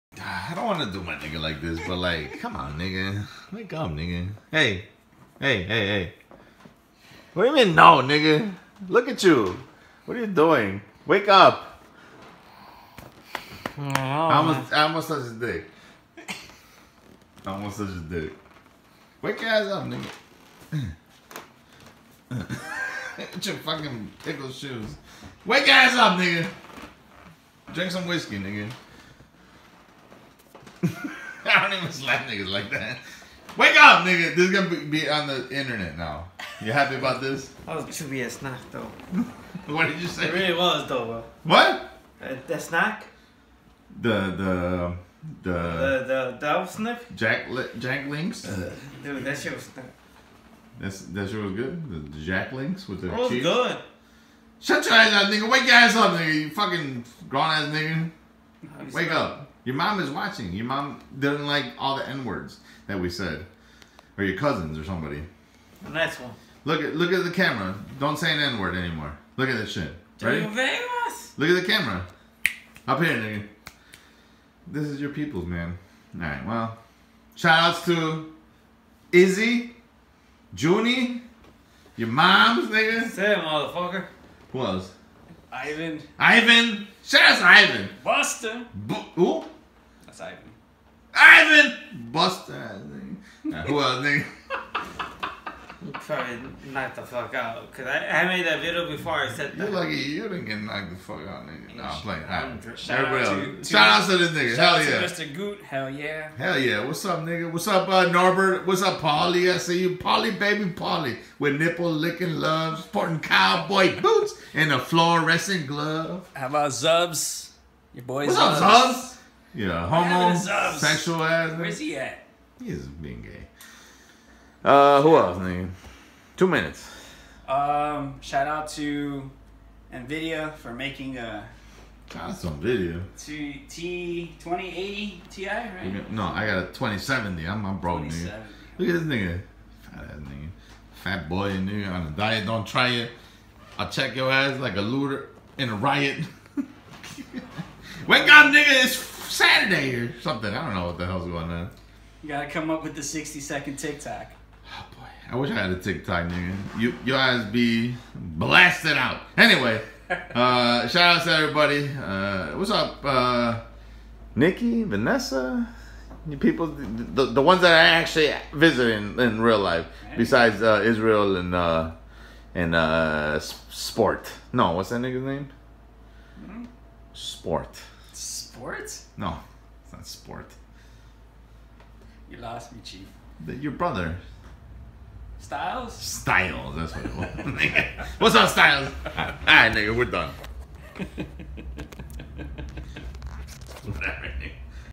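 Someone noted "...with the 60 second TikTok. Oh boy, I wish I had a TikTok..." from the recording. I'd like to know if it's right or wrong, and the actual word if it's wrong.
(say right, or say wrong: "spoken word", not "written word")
right.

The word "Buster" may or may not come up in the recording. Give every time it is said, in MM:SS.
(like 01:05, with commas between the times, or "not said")
01:28, 01:32.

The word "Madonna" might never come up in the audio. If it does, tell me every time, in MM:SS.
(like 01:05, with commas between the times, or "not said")
not said.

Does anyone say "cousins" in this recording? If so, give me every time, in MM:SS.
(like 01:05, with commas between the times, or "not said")
01:04.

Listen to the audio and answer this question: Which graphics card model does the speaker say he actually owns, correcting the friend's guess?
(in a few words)
2070.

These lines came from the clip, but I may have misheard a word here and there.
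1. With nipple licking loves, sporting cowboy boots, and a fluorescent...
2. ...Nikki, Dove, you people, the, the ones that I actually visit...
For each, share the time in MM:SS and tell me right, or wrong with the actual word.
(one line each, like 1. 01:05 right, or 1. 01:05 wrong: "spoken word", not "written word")
1. 01:51 right
2. 02:44 wrong: "Vanessa", not "Dove".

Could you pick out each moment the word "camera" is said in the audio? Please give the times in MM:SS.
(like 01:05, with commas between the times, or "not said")
01:07, 01:11.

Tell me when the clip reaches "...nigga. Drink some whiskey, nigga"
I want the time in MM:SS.
00:26.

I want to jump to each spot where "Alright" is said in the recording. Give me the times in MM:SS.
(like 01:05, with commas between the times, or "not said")
03:09.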